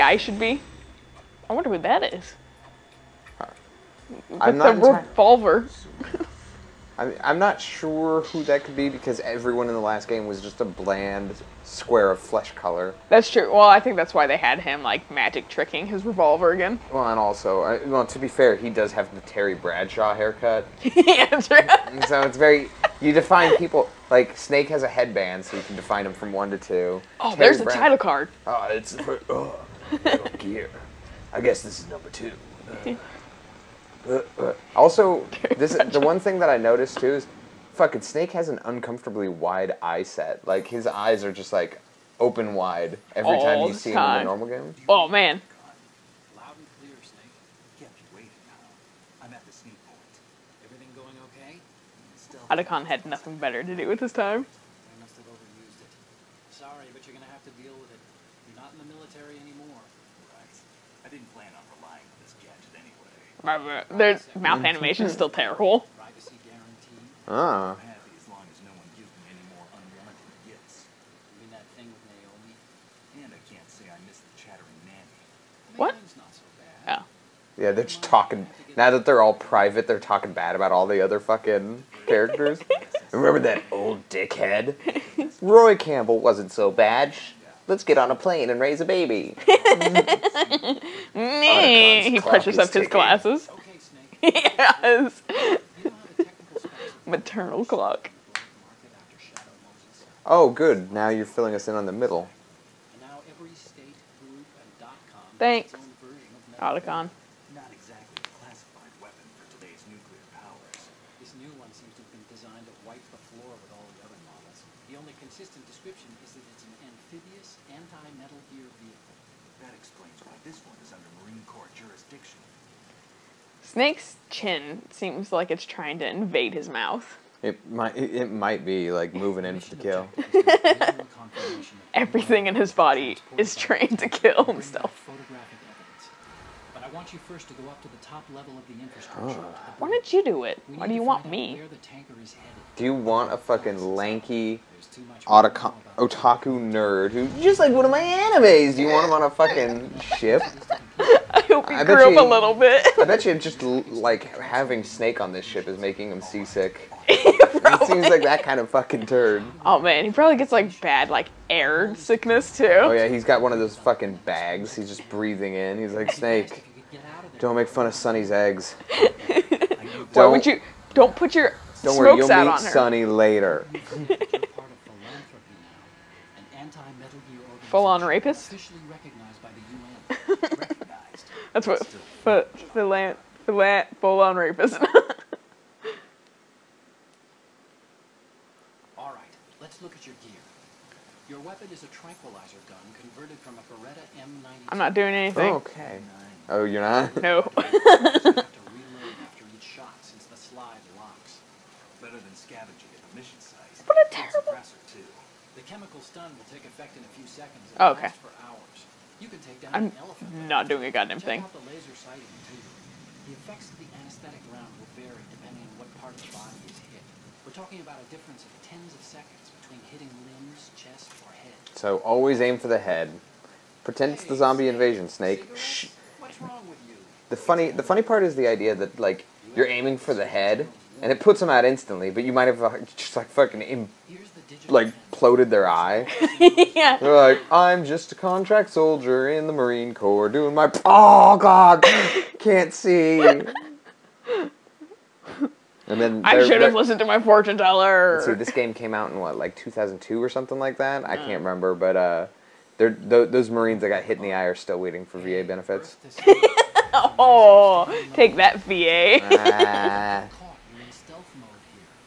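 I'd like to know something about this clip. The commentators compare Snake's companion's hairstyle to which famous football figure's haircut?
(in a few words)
Terry Bradshaw.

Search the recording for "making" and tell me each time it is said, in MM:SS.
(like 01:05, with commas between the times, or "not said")
02:35.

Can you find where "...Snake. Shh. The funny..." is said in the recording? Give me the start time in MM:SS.
03:45.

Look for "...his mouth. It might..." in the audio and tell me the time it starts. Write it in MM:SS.
02:06.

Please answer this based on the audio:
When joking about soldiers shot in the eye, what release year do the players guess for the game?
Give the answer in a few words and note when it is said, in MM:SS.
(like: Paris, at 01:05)
2002, at 04:09.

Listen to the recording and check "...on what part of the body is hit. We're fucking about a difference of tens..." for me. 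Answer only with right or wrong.
wrong.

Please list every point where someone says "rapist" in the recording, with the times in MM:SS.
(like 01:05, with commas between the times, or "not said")
02:58, 03:04.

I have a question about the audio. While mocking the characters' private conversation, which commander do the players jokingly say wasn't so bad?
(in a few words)
Roy Campbell.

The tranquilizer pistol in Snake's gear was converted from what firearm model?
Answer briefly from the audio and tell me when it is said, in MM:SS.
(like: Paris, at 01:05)
Beretta M90, at 03:13.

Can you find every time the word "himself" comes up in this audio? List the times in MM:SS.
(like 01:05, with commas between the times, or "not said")
02:14.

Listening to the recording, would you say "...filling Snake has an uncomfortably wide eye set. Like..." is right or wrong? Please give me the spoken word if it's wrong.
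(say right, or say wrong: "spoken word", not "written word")
wrong: "fucking", not "filling".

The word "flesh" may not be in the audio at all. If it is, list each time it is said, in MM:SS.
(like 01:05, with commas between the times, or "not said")
00:12.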